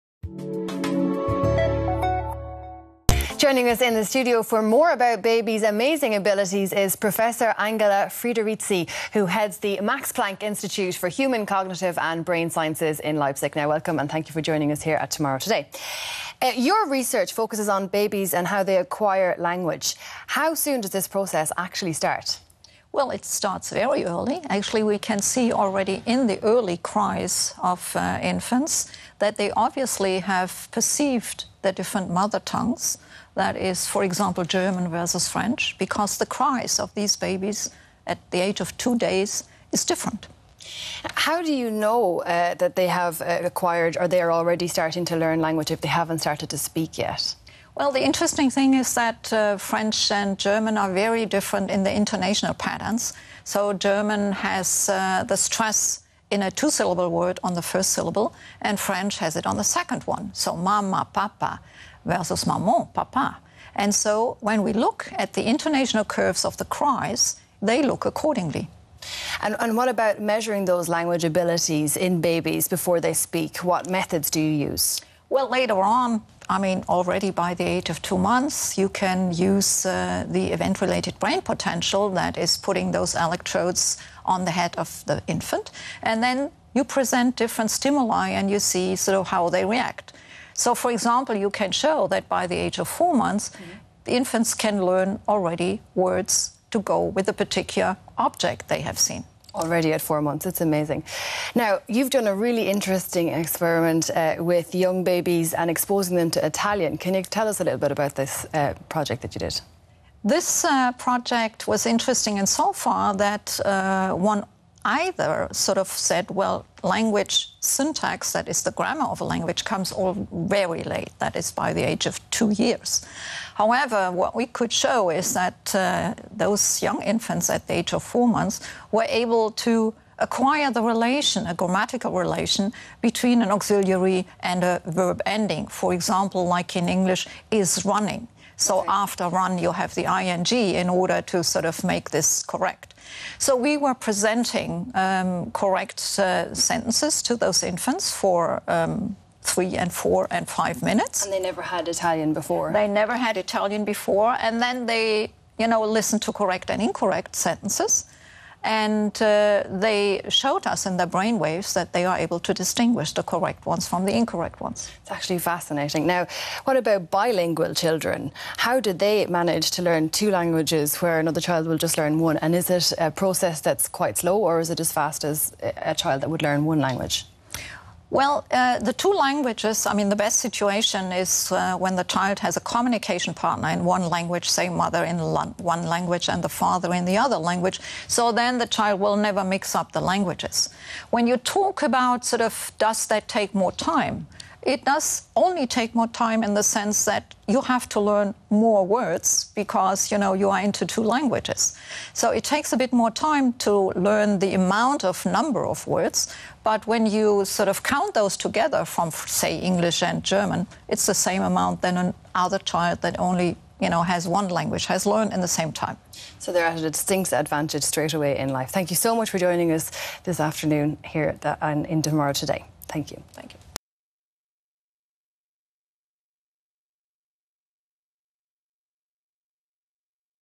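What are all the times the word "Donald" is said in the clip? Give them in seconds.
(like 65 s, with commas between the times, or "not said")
not said.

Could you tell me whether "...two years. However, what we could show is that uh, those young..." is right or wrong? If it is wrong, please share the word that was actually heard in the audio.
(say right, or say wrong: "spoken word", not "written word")
right.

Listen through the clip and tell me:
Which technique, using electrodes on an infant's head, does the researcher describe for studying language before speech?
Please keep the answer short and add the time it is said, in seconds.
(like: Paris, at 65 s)
Event related brain potential, at 80 s.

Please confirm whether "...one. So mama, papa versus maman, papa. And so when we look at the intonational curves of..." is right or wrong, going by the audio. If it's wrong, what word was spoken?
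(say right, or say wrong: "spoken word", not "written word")
right.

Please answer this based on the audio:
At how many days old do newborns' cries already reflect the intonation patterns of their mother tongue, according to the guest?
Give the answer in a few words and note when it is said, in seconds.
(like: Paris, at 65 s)
2 days, at 38 s.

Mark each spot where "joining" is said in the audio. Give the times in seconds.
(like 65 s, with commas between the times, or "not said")
3 s, 14 s, 219 s.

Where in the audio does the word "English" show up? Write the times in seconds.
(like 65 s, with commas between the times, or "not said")
136 s, 209 s.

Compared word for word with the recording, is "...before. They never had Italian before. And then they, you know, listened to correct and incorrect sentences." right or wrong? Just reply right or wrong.
right.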